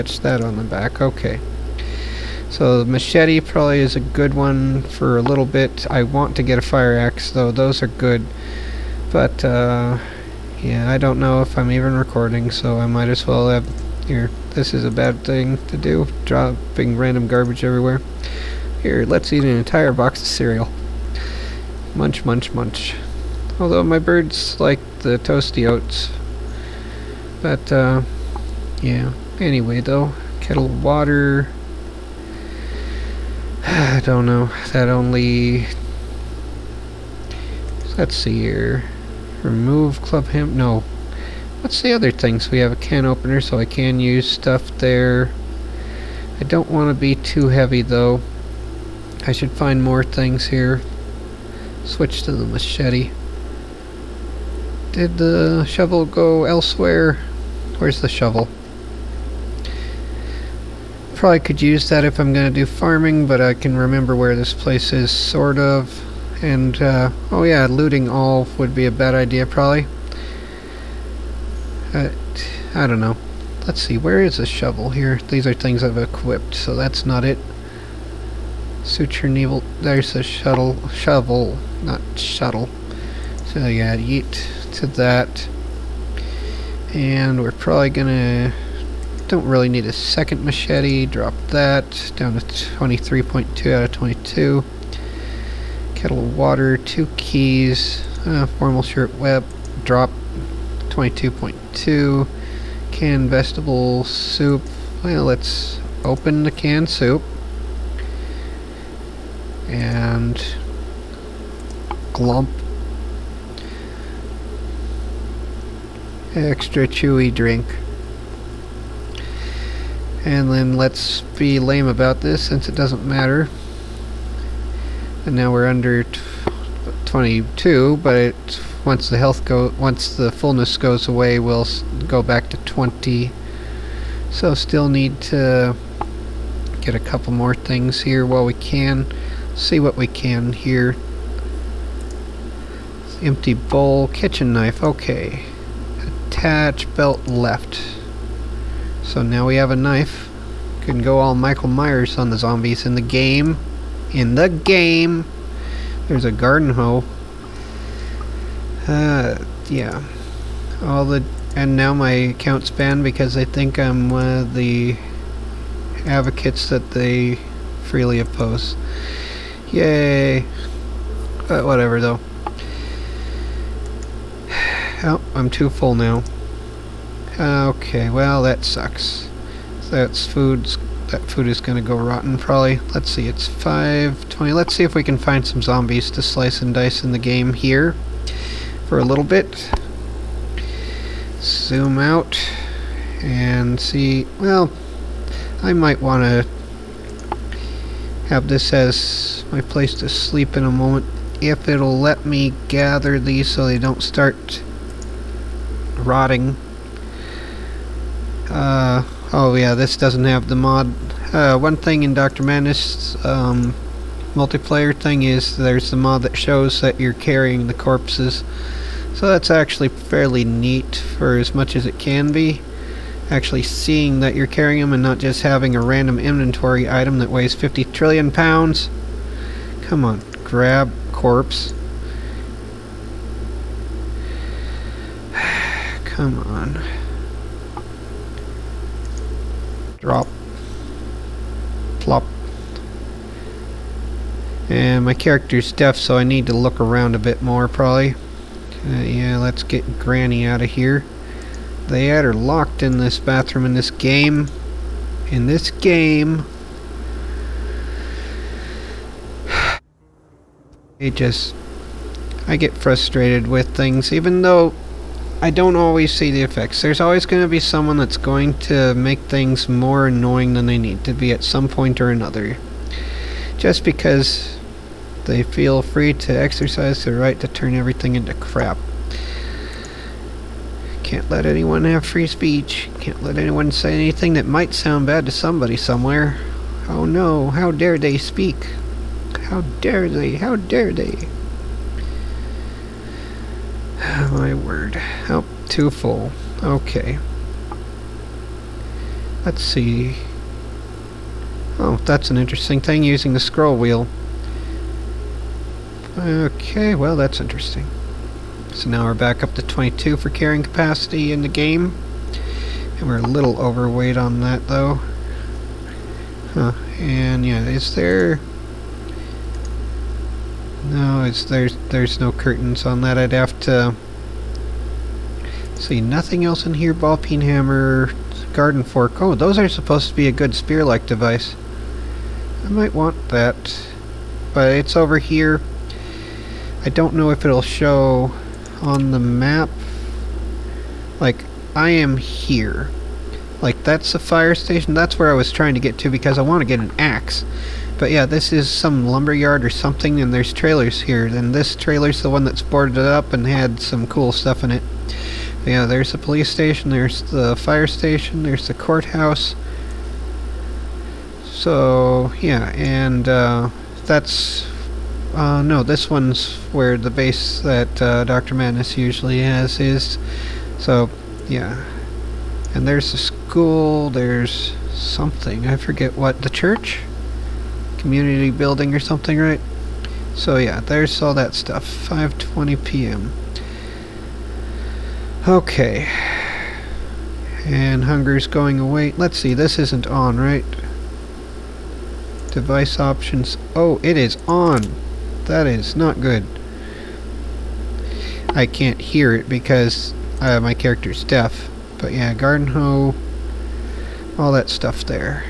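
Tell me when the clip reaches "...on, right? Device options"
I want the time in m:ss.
6:30.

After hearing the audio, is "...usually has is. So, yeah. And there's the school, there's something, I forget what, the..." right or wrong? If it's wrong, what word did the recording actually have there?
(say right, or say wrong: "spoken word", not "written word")
right.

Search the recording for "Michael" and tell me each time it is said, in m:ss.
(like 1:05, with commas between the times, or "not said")
2:31.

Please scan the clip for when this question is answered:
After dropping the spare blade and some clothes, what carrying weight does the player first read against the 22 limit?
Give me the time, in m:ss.
1:32.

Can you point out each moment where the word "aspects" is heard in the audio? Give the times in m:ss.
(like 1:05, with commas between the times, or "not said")
not said.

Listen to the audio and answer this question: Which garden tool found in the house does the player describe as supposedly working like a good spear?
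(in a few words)
Garden fork.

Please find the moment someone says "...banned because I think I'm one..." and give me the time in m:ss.
2:42.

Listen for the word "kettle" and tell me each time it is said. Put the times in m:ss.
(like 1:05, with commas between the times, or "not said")
0:30, 1:35.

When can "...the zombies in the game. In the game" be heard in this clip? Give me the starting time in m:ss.
2:32.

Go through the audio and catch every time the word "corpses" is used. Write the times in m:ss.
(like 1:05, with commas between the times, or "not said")
3:37, 3:51.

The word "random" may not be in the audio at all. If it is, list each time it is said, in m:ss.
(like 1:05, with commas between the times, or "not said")
0:16, 3:45.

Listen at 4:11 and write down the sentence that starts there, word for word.
They had her locked in this bathroom in this game.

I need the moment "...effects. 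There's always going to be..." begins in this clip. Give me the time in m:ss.
4:26.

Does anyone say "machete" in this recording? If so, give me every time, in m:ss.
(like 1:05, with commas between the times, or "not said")
0:02, 0:52, 1:30.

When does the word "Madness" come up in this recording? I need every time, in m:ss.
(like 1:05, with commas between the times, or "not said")
3:32, 6:08.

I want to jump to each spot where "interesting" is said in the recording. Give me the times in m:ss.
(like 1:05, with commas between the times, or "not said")
5:02, 5:07.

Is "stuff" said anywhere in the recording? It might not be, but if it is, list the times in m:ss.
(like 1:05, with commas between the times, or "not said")
0:44, 5:54, 6:21, 6:44.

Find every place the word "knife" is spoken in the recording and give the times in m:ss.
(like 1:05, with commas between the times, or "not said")
2:24, 2:29.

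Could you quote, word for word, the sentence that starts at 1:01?
Probably could use that if I'm going to do farming, but I can remember where this place is, sort of.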